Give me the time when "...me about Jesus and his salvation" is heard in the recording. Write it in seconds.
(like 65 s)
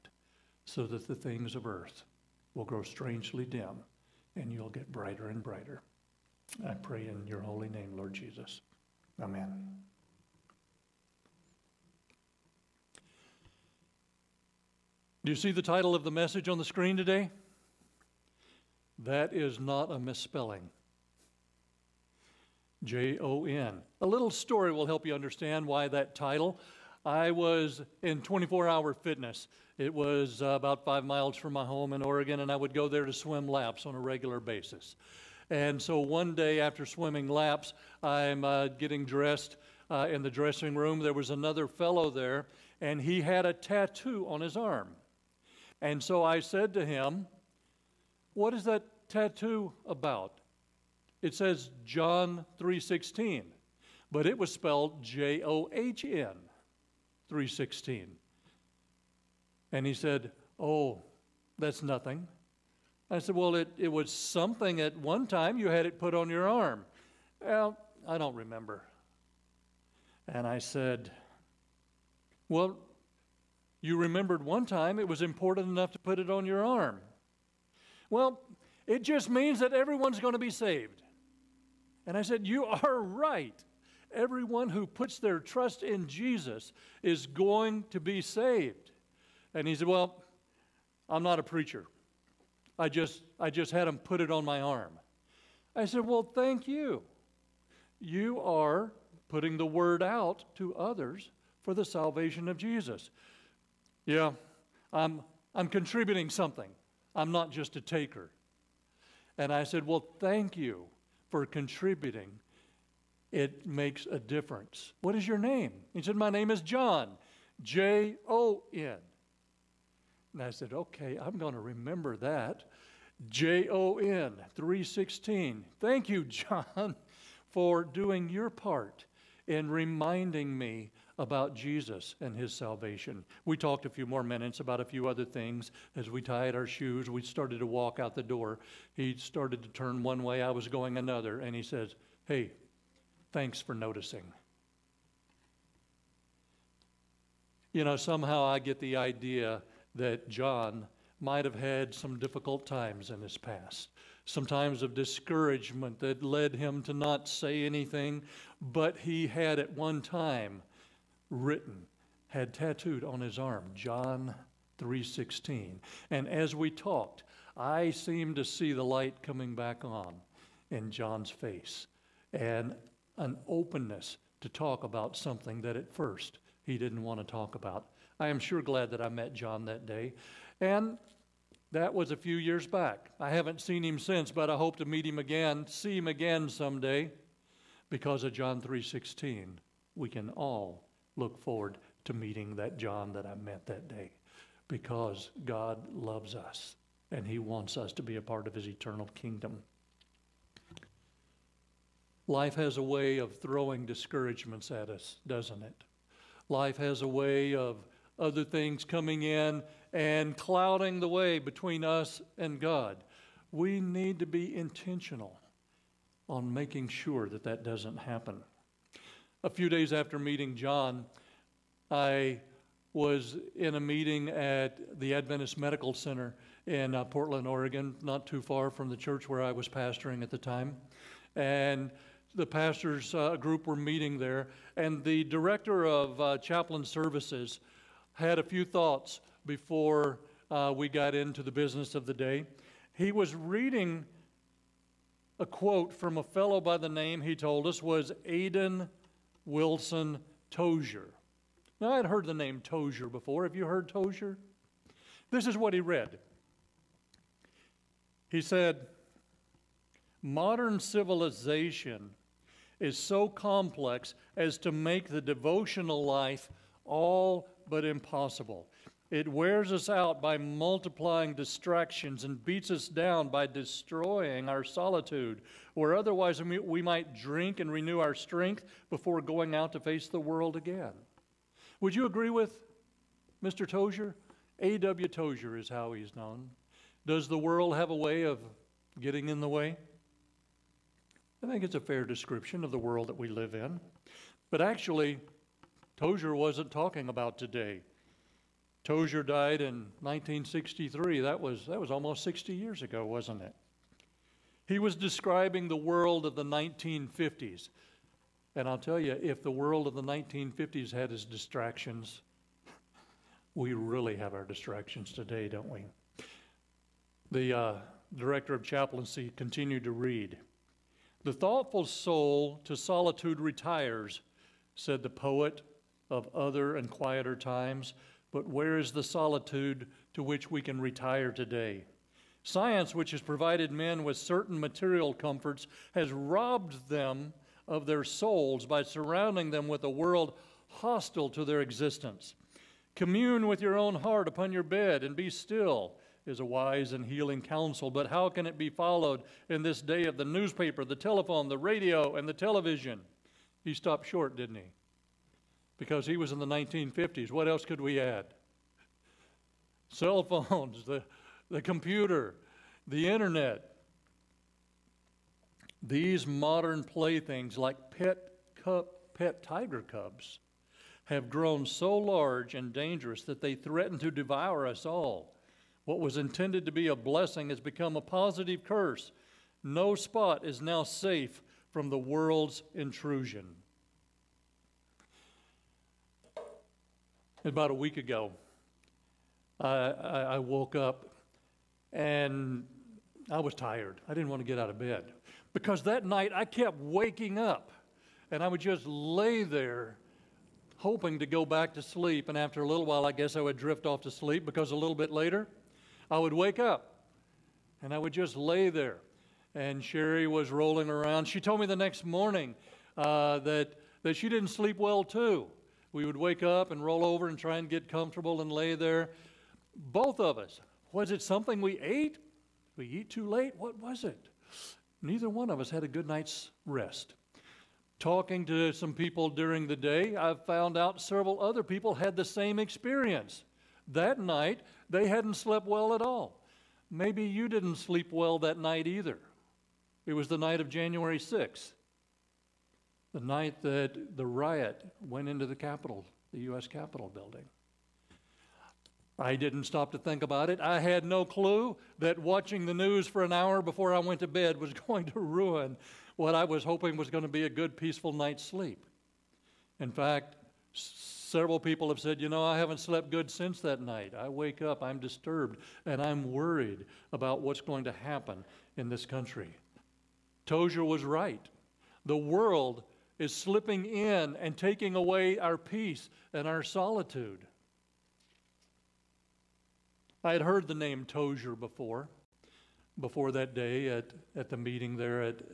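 130 s.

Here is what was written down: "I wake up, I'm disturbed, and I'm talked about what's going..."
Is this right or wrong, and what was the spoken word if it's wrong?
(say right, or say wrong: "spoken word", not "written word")
wrong: "worried", not "talked".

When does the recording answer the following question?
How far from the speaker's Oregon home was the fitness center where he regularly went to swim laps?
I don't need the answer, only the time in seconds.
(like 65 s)
30 s.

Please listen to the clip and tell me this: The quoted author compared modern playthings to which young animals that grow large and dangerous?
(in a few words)
Tiger cubs.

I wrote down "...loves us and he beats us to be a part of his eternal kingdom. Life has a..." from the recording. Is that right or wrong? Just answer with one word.
wrong.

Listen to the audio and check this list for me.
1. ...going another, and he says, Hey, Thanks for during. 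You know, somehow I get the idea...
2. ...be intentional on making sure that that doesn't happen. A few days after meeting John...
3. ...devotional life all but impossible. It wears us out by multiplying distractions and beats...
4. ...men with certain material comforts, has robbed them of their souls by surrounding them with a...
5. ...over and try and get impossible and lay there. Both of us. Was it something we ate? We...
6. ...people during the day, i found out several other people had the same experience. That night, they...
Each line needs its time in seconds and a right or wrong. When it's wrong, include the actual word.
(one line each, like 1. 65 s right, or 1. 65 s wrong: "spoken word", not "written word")
1. 140 s wrong: "noticing", not "during"
2. 214 s right
3. 265 s right
4. 333 s right
5. 417 s wrong: "comfortable", not "impossible"
6. 428 s right.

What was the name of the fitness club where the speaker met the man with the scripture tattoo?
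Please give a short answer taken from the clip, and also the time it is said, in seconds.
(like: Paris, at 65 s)
24 Hour Fitness, at 28 s.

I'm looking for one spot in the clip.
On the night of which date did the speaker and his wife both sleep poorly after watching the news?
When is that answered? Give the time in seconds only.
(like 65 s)
440 s.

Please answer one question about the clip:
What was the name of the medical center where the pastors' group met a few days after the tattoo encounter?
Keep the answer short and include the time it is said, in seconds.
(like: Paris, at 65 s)
Adventist Medical Center, at 225 s.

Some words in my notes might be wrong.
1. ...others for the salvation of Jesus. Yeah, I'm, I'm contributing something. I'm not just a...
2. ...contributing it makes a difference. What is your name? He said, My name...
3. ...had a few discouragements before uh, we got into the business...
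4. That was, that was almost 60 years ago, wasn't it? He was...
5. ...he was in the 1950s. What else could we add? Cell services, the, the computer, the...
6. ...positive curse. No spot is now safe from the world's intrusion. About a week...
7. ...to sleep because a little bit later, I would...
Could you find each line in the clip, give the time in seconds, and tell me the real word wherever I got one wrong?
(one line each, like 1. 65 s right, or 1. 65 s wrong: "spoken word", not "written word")
1. 100 s right
2. 111 s right
3. 238 s wrong: "thoughts", not "discouragements"
4. 301 s right
5. 356 s wrong: "phones", not "services"
6. 378 s right
7. 404 s right.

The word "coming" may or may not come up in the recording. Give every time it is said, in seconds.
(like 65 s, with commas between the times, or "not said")
169 s, 208 s.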